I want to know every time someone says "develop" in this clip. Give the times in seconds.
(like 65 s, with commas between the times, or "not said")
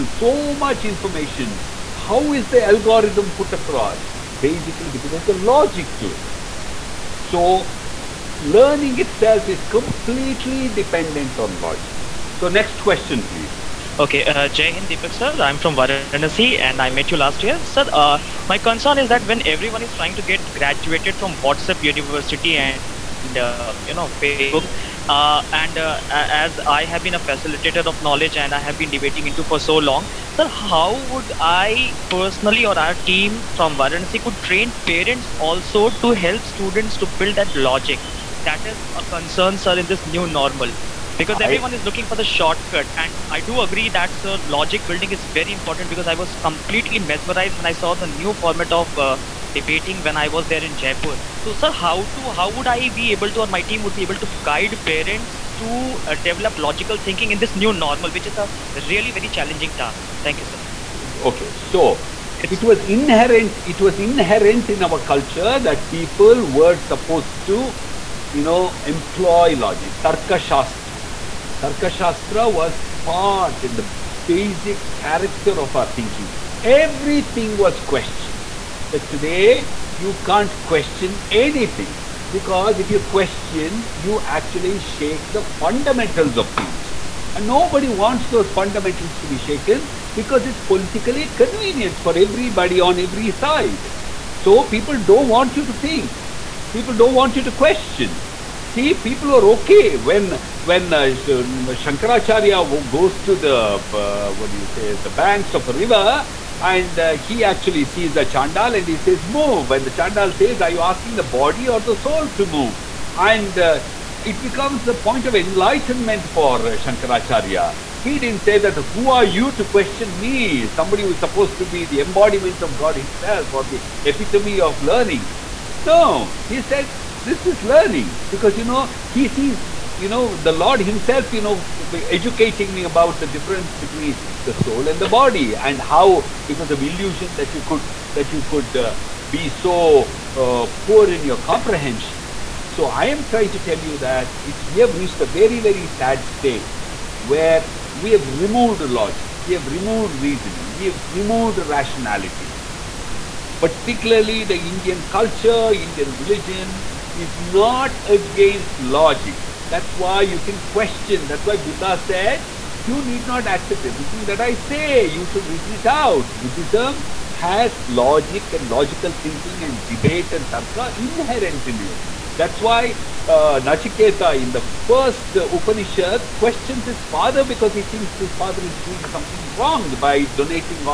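56 s.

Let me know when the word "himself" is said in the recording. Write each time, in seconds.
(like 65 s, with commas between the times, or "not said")
122 s, 130 s.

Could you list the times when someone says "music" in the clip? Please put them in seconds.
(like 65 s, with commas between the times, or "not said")
not said.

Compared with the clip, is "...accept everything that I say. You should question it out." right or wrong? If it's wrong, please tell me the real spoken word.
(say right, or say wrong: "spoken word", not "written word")
wrong: "reason", not "question".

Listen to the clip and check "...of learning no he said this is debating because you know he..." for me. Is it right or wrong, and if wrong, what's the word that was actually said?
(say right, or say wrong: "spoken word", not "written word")
wrong: "learning", not "debating".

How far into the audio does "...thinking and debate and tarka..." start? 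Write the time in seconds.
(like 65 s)
169 s.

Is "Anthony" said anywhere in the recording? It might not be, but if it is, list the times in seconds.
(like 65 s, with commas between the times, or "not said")
not said.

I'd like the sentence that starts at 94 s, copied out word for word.
So people don't want you to think.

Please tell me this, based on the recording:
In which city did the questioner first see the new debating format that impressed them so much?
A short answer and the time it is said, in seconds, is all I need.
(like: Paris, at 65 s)
Jaipur, at 50 s.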